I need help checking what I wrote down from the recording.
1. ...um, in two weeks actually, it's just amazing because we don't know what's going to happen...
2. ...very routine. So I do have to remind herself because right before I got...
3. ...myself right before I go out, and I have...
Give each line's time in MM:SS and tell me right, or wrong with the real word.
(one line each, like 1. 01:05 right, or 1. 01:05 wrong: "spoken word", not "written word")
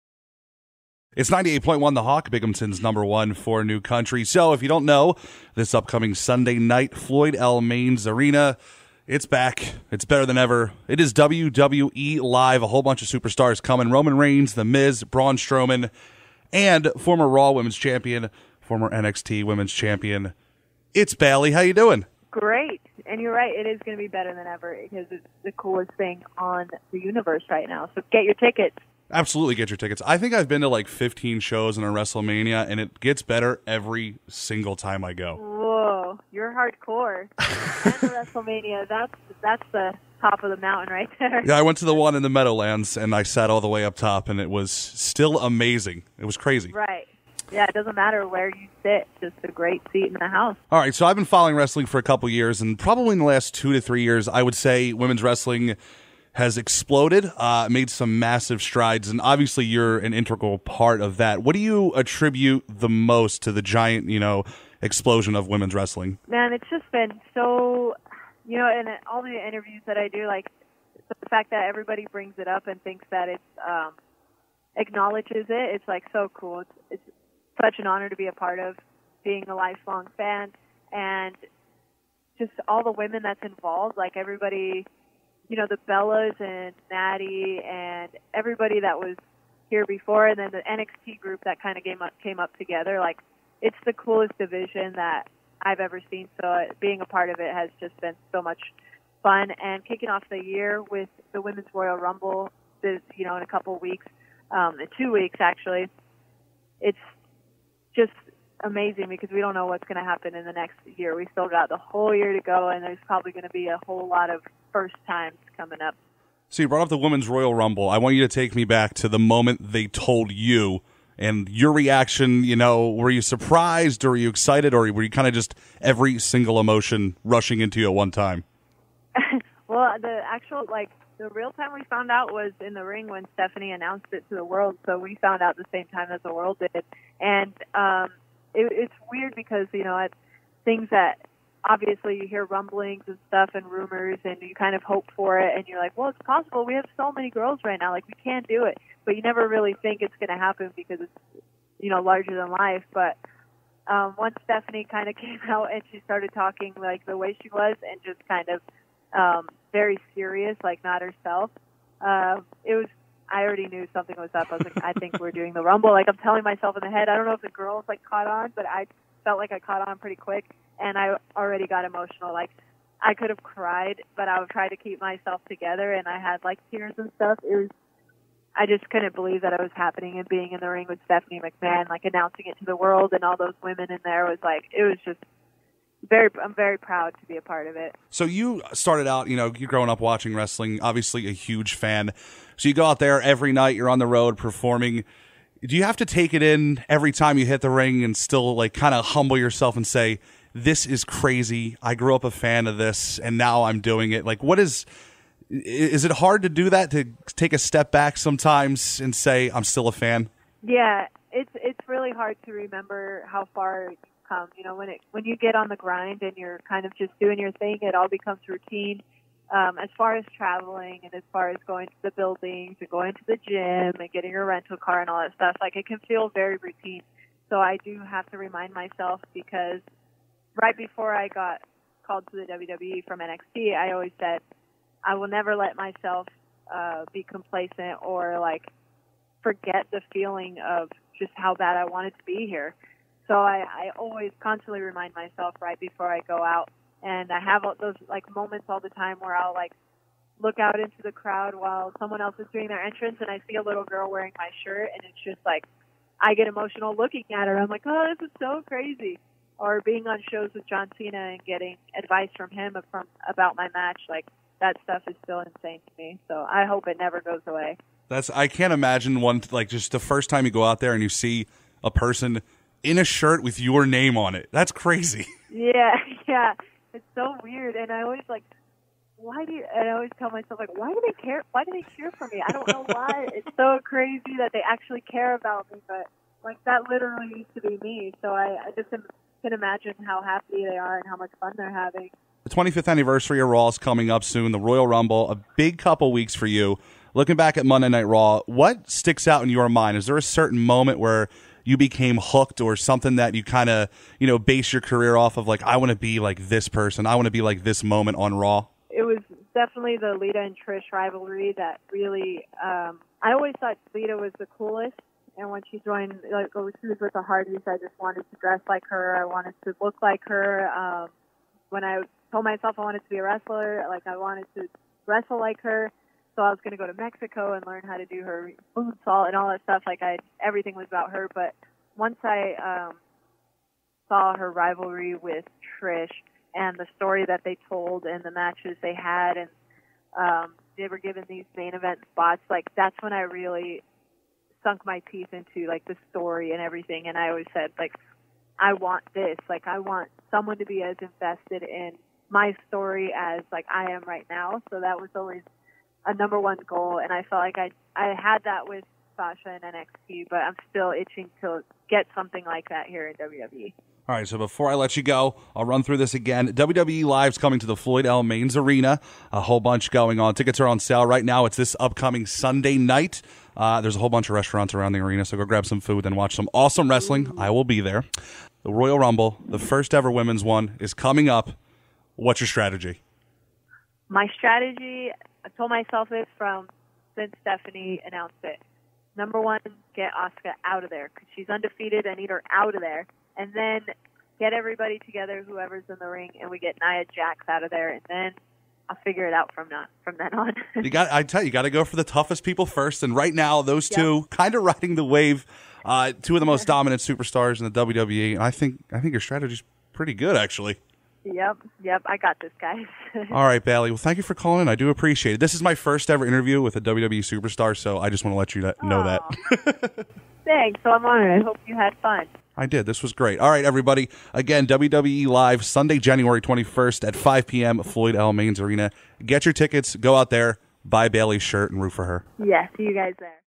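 1. 01:44 right
2. 03:46 wrong: "myself", not "herself"
3. 04:05 right.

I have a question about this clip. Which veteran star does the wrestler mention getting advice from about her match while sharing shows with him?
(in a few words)
John Cena.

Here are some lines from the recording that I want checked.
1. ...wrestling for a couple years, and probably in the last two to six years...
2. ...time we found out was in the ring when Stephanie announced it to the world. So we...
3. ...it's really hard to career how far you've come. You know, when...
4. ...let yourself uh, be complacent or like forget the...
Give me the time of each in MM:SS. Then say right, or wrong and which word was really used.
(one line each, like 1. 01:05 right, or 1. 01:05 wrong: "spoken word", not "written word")
1. 00:51 wrong: "three", not "six"
2. 02:11 right
3. 03:31 wrong: "remember", not "career"
4. 03:55 wrong: "myself", not "yourself".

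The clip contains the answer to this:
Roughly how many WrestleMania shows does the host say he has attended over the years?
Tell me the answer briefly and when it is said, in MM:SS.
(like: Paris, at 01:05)
15, at 00:30.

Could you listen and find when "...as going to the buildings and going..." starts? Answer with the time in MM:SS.
03:41.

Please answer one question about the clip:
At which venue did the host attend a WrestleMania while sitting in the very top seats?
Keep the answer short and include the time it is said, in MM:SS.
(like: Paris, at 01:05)
The Meadowlands, at 00:42.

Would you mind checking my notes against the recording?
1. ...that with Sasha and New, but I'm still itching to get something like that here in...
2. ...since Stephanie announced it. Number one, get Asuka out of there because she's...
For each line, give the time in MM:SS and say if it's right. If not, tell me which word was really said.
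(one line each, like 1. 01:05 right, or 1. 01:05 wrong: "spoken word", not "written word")
1. 05:58 wrong: "NXT", not "New"
2. 06:27 right.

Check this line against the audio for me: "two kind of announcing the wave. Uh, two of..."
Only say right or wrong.
wrong.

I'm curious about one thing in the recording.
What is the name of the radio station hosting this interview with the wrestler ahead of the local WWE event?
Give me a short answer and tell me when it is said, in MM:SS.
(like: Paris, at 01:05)
98.1 The Hawk, at 00:01.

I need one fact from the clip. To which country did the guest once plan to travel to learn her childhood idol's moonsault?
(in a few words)
Mexico.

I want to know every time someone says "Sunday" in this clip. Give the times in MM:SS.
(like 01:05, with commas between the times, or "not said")
00:06, 06:12, 07:05.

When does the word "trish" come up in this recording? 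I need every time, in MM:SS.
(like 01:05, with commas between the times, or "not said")
05:10, 05:35.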